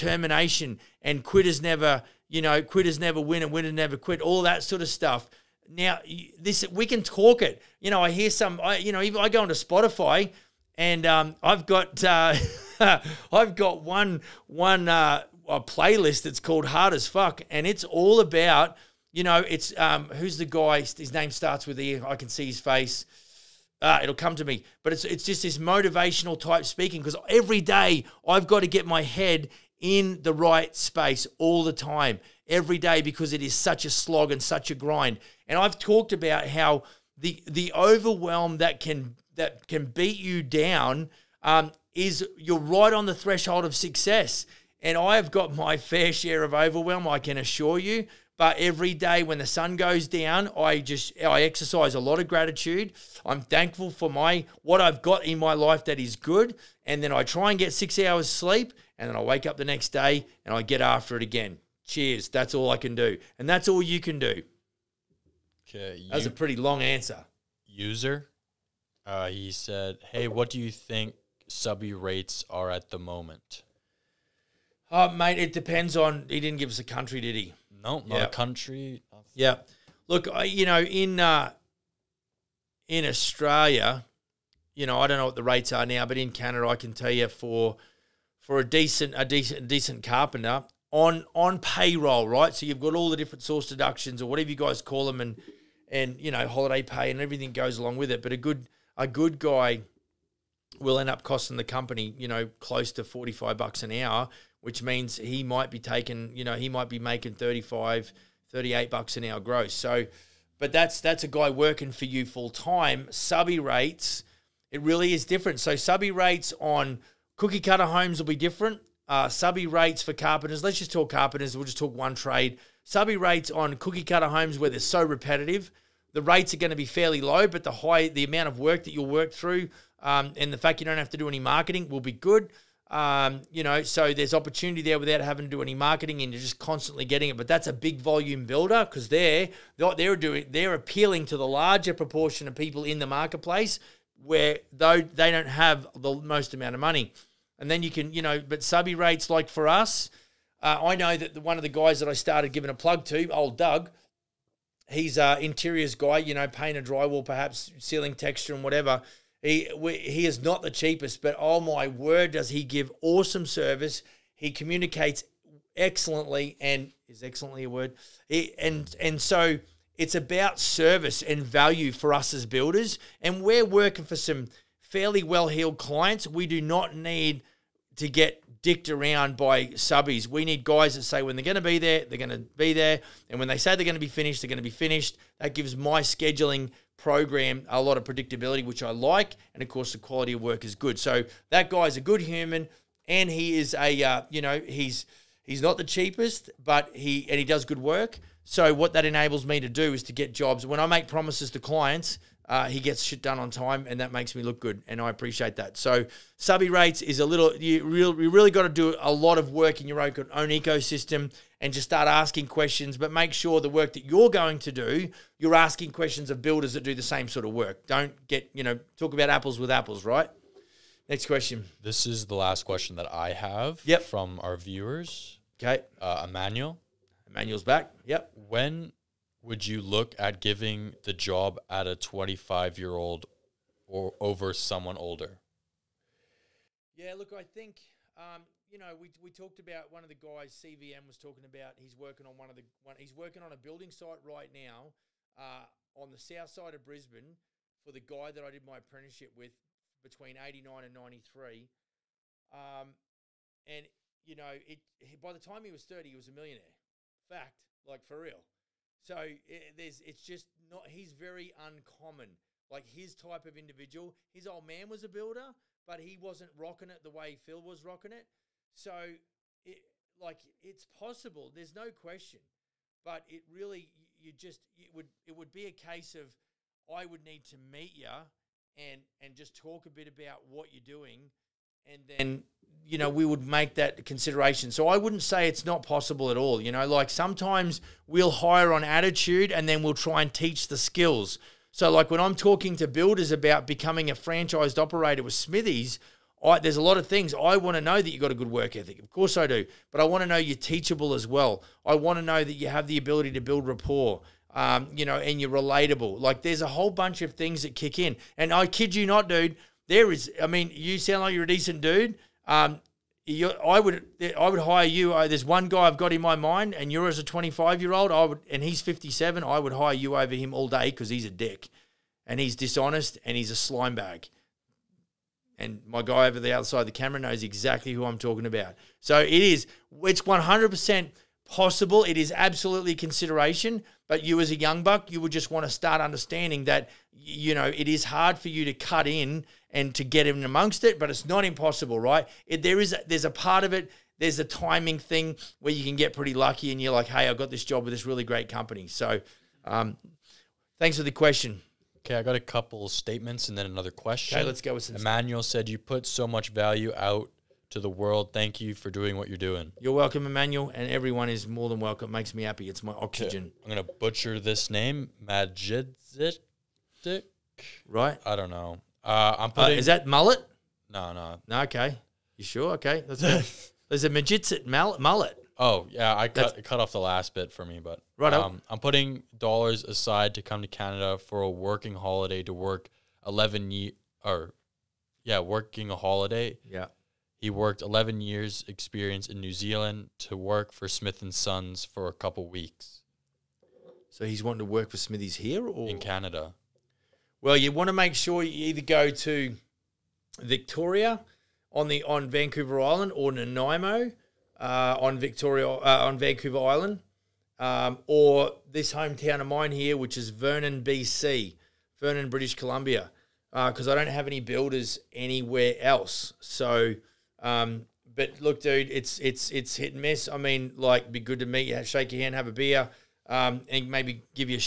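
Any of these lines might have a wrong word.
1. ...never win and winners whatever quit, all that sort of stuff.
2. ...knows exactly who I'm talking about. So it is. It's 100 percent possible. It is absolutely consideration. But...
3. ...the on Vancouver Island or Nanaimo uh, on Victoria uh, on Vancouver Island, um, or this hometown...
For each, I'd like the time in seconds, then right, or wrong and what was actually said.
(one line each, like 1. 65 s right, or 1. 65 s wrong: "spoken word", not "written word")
1. 2 s wrong: "never", not "whatever"
2. 327 s right
3. 401 s right.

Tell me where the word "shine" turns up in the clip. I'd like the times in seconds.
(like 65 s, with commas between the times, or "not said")
not said.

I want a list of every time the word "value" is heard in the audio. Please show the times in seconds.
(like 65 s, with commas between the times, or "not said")
171 s, 356 s.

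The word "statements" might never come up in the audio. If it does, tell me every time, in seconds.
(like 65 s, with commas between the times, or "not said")
352 s.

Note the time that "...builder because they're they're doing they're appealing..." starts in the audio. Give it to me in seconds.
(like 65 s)
138 s.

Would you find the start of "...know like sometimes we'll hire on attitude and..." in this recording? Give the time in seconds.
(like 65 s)
286 s.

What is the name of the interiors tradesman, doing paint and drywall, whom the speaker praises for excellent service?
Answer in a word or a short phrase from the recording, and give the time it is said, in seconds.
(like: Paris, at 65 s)
Doug, at 153 s.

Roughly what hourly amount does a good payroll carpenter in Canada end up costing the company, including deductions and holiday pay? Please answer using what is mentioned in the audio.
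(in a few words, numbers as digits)
45 bucks an hour.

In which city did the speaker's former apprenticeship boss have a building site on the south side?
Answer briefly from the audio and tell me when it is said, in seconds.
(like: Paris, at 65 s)
Brisbane, at 246 s.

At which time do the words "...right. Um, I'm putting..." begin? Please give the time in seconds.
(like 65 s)
378 s.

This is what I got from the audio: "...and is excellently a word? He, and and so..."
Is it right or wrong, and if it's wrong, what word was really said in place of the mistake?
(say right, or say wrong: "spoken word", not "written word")
right.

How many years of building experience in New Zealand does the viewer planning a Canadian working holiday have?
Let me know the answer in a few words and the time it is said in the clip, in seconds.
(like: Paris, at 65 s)
11, at 387 s.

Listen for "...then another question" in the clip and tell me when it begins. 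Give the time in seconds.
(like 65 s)
353 s.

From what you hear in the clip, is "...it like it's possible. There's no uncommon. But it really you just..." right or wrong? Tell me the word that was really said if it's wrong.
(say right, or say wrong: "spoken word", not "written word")
wrong: "question", not "uncommon".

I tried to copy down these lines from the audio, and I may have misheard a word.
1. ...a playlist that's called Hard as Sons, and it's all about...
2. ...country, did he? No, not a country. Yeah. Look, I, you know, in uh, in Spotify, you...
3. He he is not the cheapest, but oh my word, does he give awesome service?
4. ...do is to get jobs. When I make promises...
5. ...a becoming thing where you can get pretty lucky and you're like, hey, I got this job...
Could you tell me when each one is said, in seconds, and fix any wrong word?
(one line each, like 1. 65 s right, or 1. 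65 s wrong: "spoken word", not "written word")
1. 15 s wrong: "Fuck", not "Sons"
2. 76 s wrong: "Australia", not "Spotify"
3. 159 s right
4. 199 s right
5. 344 s wrong: "timing", not "becoming".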